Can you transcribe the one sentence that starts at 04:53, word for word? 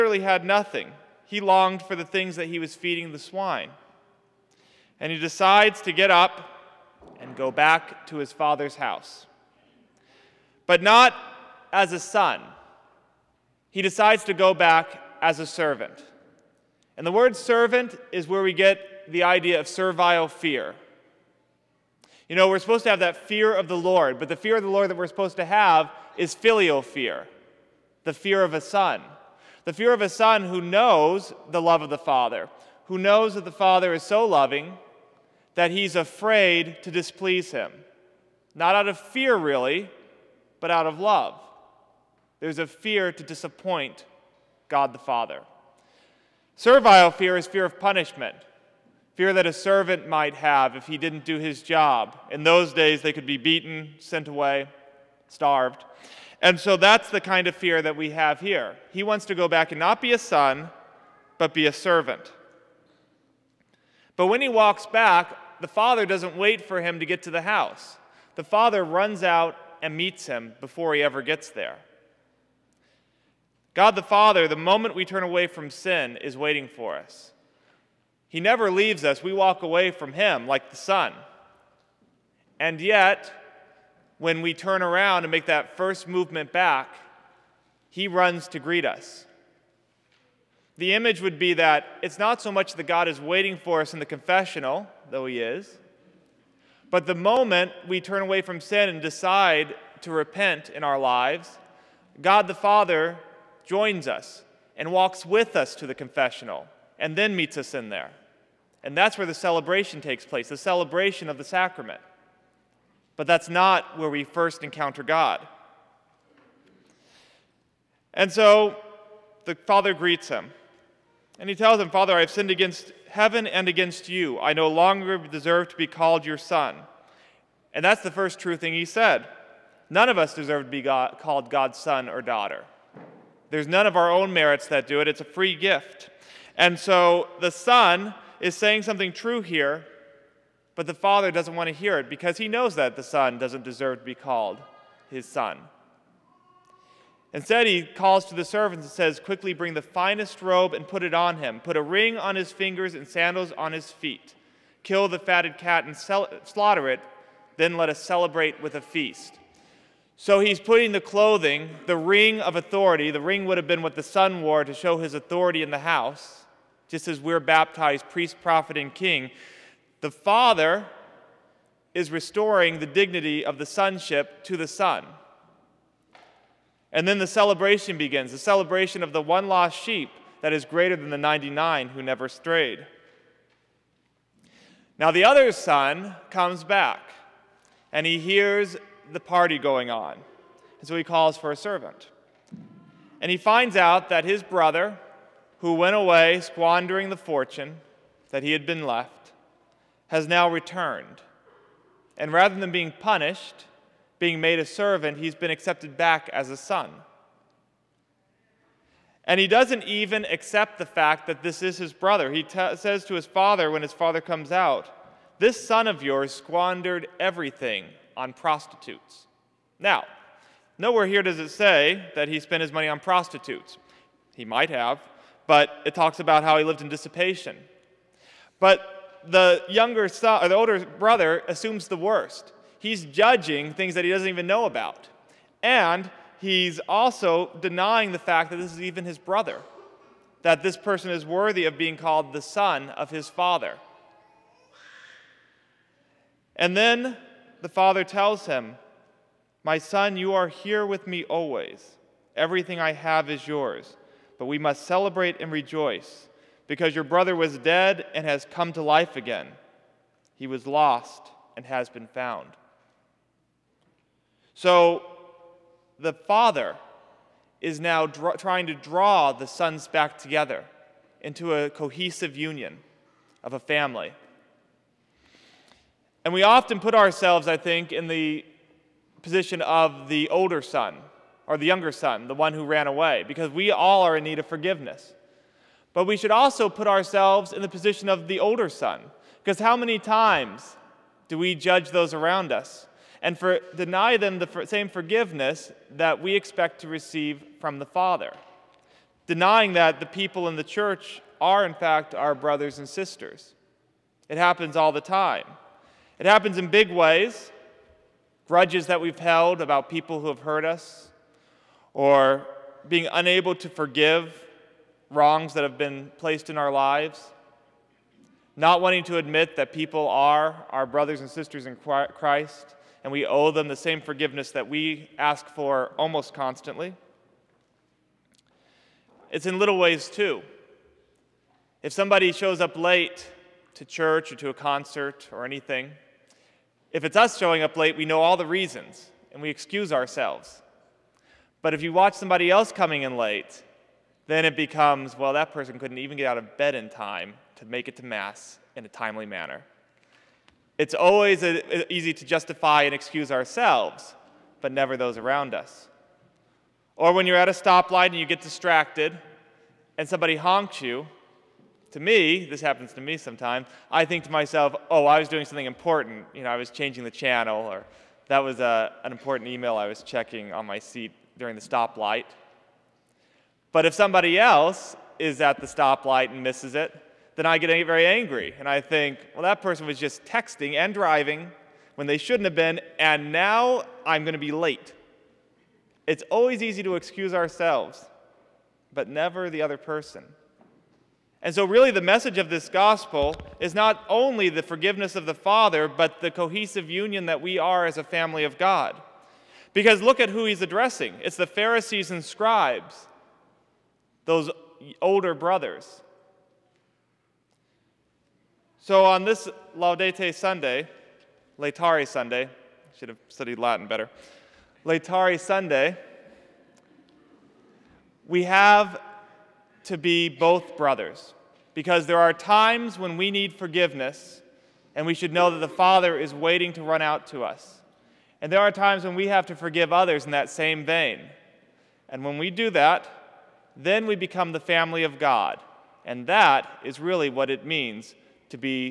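and for, deny them the same forgiveness that we expect to receive from the Father.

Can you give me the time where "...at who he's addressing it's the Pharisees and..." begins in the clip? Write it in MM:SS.
06:40.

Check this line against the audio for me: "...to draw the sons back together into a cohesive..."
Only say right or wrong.
right.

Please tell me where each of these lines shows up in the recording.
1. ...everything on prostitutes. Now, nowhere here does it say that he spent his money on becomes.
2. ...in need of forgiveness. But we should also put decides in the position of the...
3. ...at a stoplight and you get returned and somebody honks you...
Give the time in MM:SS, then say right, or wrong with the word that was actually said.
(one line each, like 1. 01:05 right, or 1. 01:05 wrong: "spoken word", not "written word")
1. 03:37 wrong: "prostitutes", not "becomes"
2. 04:44 wrong: "ourselves", not "decides"
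3. 05:57 wrong: "distracted", not "returned".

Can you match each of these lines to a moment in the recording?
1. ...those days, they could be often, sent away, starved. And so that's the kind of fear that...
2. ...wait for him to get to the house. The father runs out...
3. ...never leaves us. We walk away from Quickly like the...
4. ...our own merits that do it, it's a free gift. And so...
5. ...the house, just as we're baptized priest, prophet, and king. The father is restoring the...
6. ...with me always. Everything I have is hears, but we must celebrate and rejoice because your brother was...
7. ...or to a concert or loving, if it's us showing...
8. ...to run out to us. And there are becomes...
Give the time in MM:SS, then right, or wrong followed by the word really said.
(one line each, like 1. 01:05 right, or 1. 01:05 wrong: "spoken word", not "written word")
1. 00:52 wrong: "beaten", not "often"
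2. 01:06 right
3. 01:18 wrong: "Him", not "Quickly"
4. 02:13 right
5. 02:45 right
6. 04:10 wrong: "yours", not "hears"
7. 05:34 wrong: "anything", not "loving"
8. 07:06 wrong: "times", not "becomes".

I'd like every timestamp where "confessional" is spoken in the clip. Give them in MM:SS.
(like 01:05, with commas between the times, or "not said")
01:34, 01:45.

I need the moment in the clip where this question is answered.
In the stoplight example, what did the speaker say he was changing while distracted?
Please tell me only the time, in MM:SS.
06:06.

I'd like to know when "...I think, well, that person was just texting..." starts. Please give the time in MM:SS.
06:18.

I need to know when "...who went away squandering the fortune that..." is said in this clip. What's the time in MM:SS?
03:15.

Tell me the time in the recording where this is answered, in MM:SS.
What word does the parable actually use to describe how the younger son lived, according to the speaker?
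03:46.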